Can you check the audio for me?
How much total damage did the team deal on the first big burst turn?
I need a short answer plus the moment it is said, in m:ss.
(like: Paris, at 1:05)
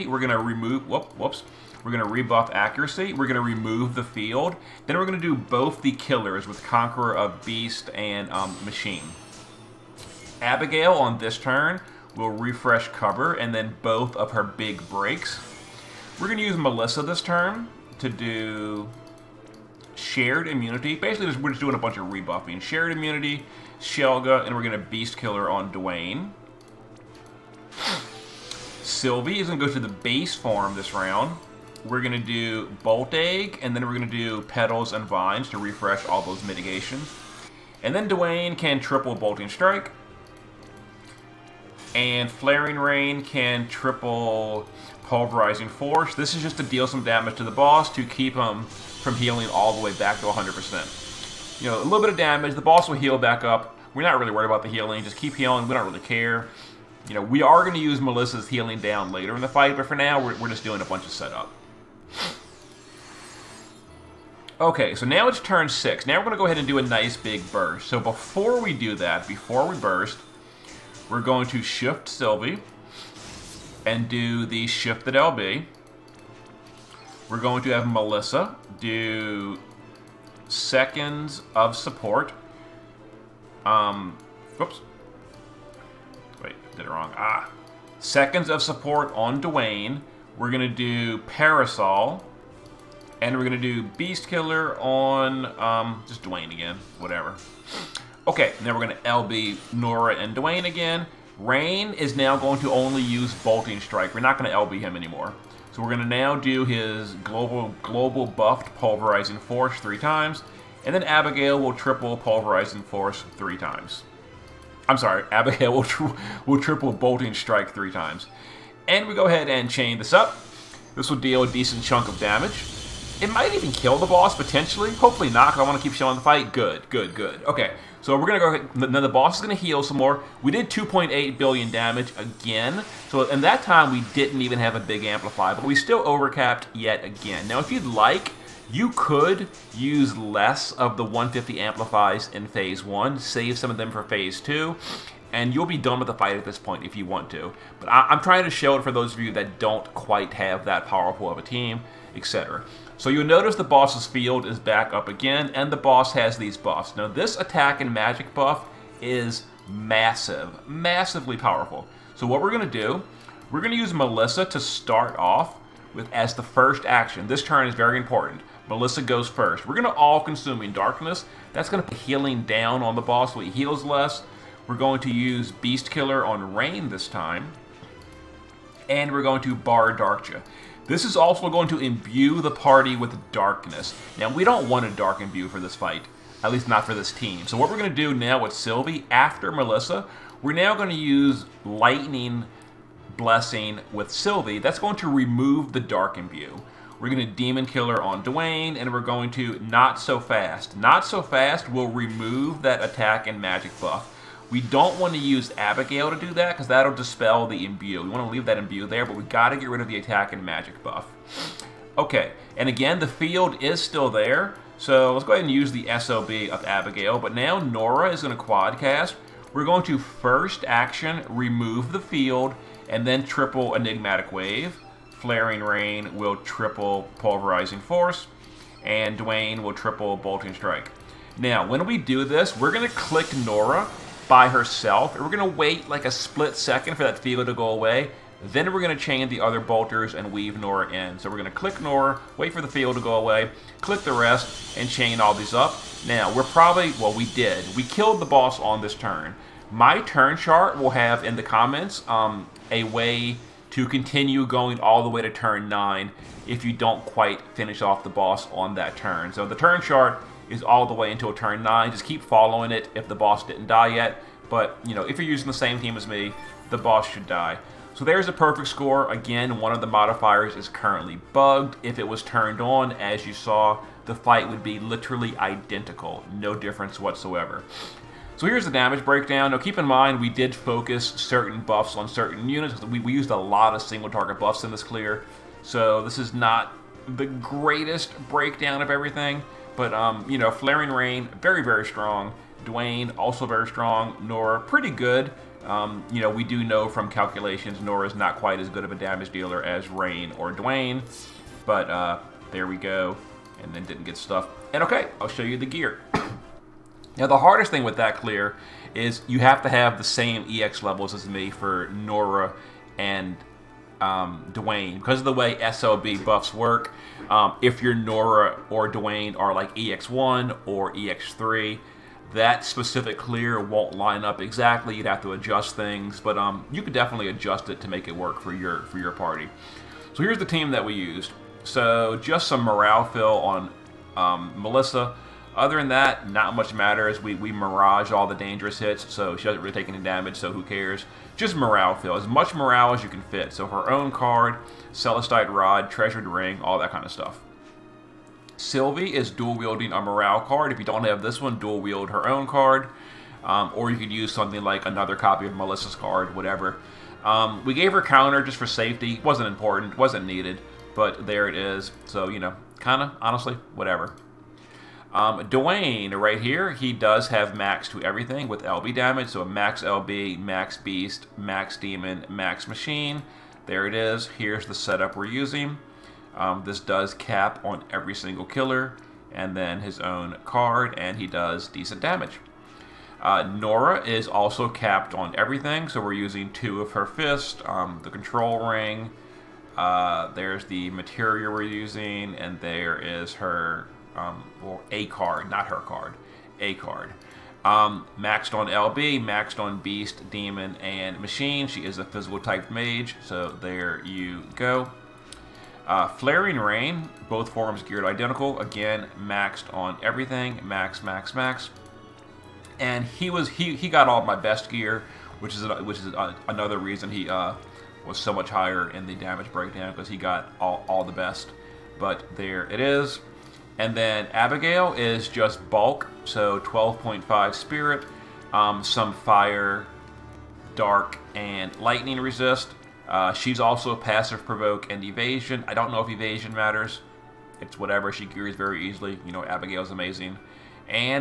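2.8 billion, at 2:10.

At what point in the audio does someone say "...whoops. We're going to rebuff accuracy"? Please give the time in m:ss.
0:01.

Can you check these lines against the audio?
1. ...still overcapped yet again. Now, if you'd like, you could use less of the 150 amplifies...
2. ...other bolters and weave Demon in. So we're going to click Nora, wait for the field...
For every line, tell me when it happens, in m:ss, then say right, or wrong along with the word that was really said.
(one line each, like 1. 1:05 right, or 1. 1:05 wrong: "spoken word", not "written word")
1. 2:15 right
2. 3:59 wrong: "Nora", not "Demon".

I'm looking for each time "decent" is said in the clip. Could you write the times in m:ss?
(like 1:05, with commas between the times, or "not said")
2:01, 6:21.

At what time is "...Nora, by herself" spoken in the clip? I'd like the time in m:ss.
3:53.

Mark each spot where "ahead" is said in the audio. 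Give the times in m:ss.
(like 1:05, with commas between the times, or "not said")
1:06, 1:59, 3:35.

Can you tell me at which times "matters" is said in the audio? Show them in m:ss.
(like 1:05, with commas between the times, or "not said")
5:36, 7:16.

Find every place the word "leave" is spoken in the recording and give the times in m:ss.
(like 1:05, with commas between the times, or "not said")
3:28.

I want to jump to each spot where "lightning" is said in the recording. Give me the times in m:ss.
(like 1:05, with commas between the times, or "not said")
3:11, 7:11.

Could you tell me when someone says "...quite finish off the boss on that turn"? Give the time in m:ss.
4:17.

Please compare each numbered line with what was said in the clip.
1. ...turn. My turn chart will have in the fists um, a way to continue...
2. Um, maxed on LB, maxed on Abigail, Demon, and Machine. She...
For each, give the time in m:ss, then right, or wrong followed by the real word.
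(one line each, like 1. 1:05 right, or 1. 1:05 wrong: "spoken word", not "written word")
1. 4:08 wrong: "comments", not "fists"
2. 6:37 wrong: "Beast", not "Abigail".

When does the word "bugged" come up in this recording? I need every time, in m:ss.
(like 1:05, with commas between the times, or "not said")
4:31.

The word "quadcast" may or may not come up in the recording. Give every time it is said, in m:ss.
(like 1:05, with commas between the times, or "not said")
3:38.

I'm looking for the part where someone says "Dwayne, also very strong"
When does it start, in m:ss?
4:52.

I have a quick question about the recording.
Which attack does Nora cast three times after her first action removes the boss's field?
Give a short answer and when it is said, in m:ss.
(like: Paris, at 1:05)
Enigmatic Wave, at 3:43.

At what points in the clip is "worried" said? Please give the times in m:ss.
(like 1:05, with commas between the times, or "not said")
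0:54.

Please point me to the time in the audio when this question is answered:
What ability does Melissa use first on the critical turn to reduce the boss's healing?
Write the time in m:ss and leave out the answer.
2:49.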